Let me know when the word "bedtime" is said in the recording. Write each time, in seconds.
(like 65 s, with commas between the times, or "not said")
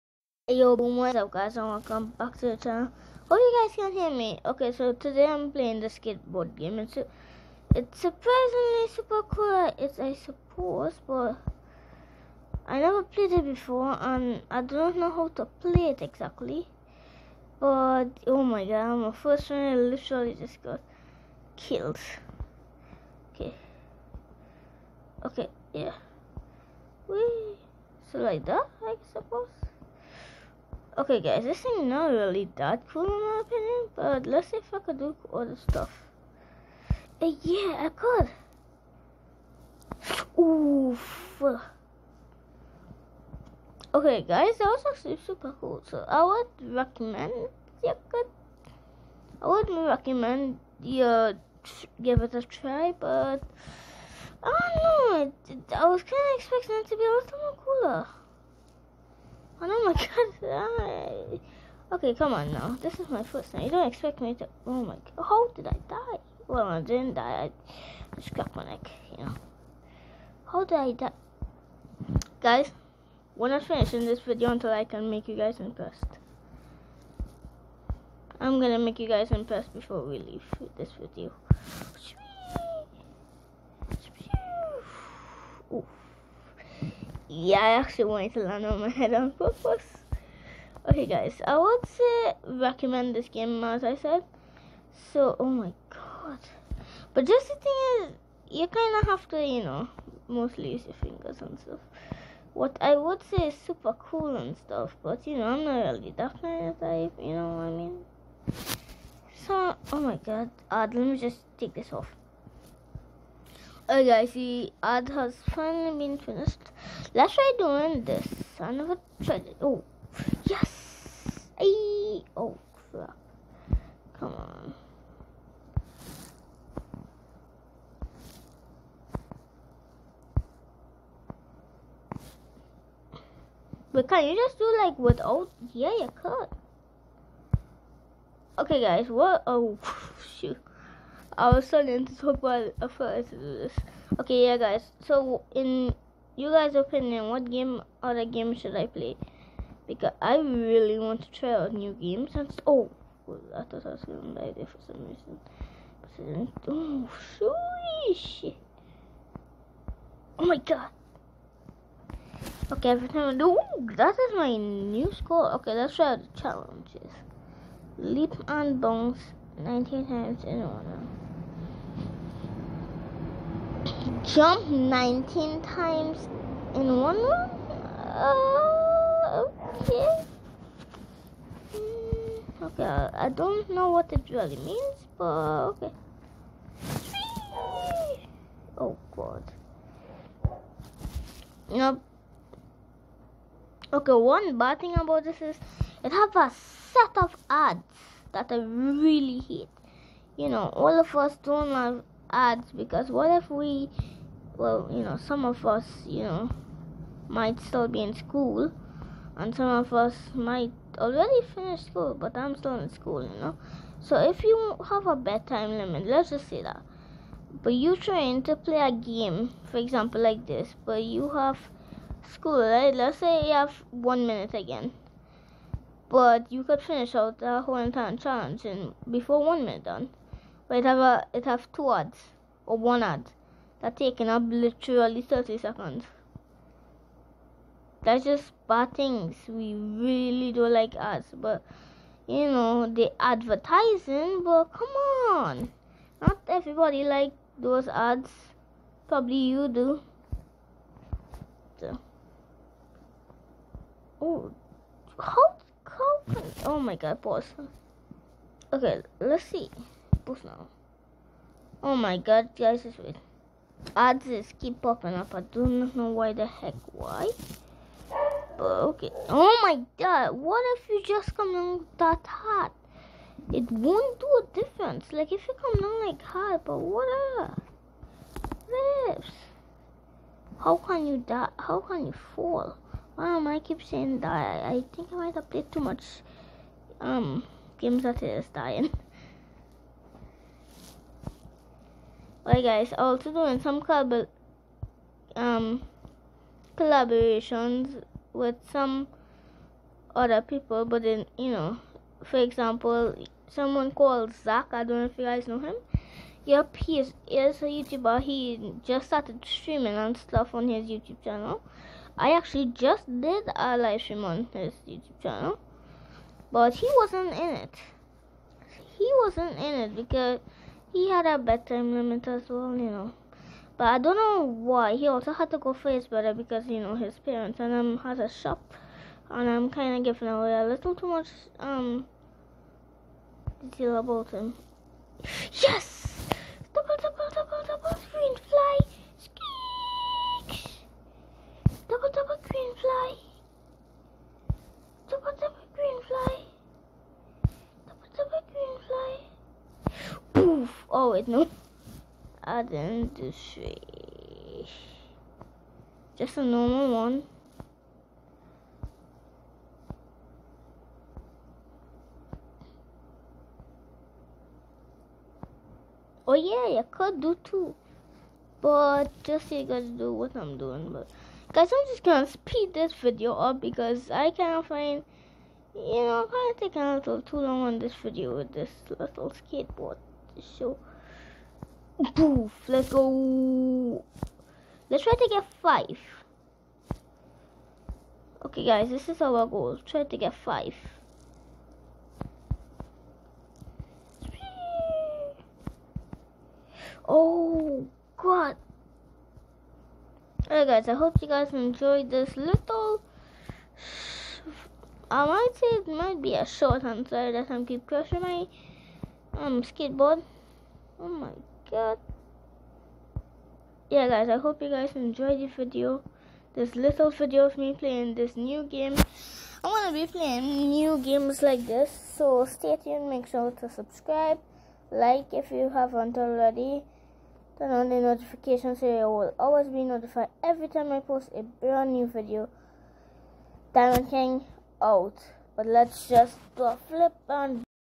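215 s, 321 s.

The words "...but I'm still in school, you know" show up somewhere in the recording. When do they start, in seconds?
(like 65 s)
212 s.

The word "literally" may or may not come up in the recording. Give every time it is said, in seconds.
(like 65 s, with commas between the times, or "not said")
19 s, 234 s.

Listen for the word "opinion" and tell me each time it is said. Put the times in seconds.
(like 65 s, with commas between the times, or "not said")
33 s, 146 s.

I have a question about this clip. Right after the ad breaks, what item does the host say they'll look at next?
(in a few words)
apples.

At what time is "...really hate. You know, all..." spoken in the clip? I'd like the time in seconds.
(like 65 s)
198 s.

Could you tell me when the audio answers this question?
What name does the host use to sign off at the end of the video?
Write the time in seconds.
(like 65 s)
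433 s.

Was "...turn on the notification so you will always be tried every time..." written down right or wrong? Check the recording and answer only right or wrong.
wrong.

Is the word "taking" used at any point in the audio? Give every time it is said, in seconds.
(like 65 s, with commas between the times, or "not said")
233 s, 376 s.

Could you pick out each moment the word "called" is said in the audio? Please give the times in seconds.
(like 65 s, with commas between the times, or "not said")
303 s.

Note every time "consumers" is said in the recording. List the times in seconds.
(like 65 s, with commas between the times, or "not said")
not said.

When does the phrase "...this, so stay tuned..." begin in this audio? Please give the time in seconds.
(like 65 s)
421 s.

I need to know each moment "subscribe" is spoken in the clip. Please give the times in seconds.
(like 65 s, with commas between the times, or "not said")
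423 s.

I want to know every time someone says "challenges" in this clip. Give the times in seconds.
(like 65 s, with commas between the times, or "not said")
166 s, 228 s.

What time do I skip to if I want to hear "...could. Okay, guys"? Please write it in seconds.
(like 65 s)
136 s.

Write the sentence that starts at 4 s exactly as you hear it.
Okay, so today I'm playing the skateboard game.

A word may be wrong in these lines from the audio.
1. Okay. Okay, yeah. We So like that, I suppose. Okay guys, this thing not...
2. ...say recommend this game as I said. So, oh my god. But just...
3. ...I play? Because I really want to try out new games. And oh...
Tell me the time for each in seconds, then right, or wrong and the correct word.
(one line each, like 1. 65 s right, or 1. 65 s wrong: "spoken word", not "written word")
1. 23 s right
2. 91 s right
3. 148 s right.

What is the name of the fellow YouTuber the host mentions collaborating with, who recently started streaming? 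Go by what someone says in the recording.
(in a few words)
Zach.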